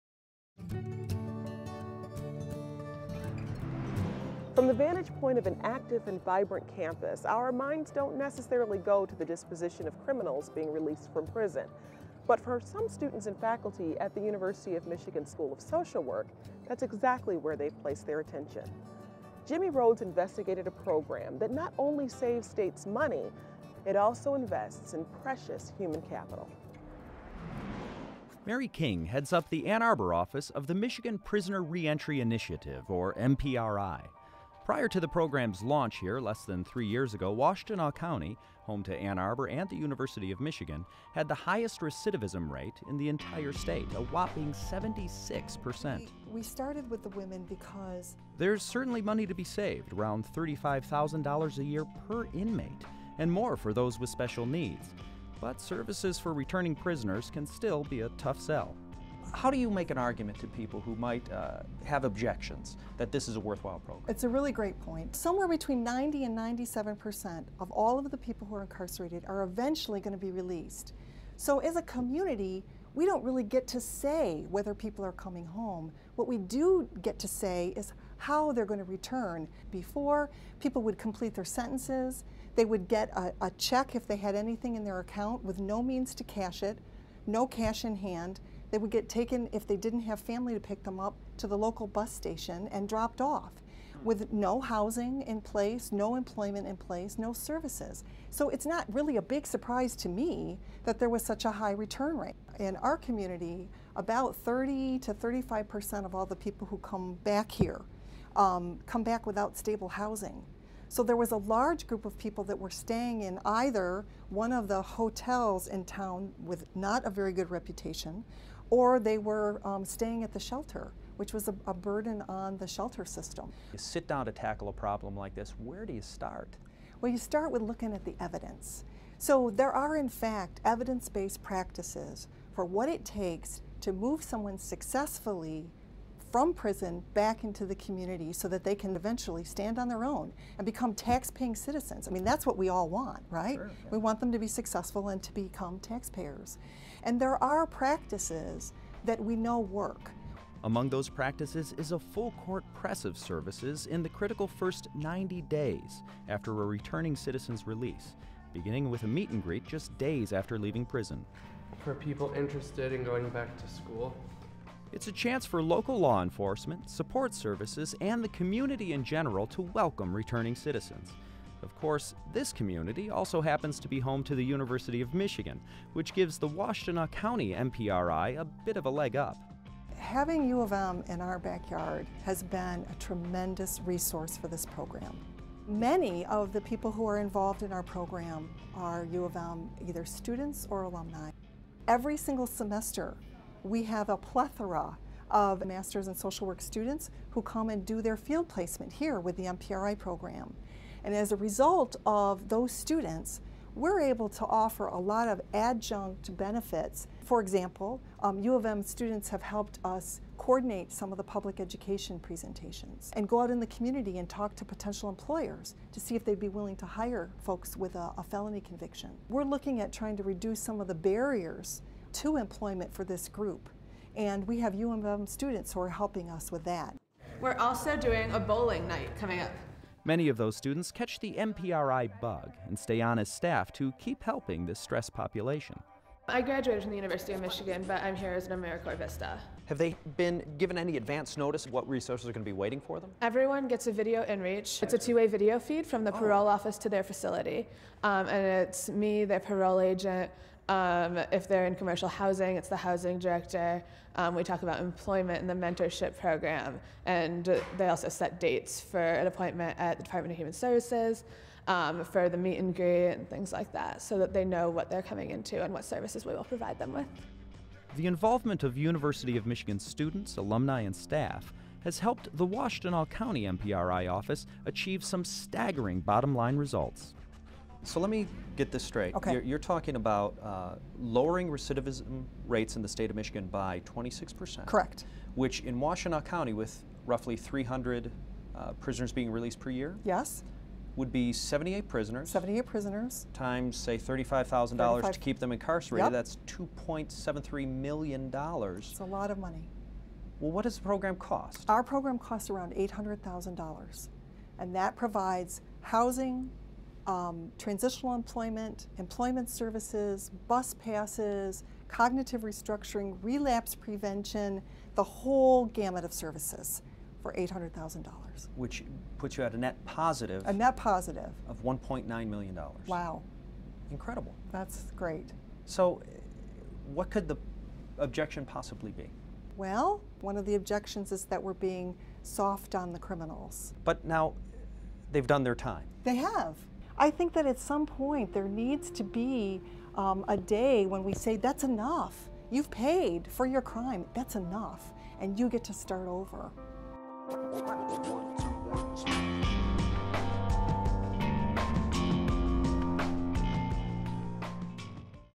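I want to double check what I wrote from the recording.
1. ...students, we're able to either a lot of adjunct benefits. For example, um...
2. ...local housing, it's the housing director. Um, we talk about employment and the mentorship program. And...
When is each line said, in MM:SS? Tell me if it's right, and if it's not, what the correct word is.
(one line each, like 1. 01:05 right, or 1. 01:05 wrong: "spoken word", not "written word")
1. 03:22 wrong: "offer", not "either"
2. 04:11 wrong: "commercial", not "local".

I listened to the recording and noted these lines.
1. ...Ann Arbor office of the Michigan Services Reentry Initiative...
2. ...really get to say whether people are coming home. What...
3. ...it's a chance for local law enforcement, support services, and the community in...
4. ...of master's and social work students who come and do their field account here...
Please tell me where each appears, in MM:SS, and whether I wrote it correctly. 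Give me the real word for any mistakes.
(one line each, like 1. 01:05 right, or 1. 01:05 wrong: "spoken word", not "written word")
1. 00:29 wrong: "Prisoner", not "Services"
2. 01:13 right
3. 02:44 right
4. 03:15 wrong: "placement", not "account".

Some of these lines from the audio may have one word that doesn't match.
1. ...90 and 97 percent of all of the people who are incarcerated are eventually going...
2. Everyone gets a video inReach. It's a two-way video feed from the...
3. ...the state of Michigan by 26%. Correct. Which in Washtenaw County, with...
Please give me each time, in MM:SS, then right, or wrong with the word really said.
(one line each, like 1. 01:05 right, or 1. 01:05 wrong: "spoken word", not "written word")
1. 01:05 right
2. 04:03 right
3. 04:42 right.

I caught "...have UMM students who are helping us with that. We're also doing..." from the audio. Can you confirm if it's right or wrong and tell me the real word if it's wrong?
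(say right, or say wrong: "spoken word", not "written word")
right.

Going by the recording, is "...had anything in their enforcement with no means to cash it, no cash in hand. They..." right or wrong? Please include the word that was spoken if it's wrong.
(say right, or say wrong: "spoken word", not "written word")
wrong: "account", not "enforcement".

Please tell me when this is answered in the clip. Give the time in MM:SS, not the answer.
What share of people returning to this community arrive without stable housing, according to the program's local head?
01:44.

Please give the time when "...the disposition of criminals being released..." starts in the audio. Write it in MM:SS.
00:09.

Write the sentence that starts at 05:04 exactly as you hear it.
And that provides housing, um, transitional employment, employment services, bus passes, cognitive restructuring, relapse prevention, the whole gamut of services for $800,000.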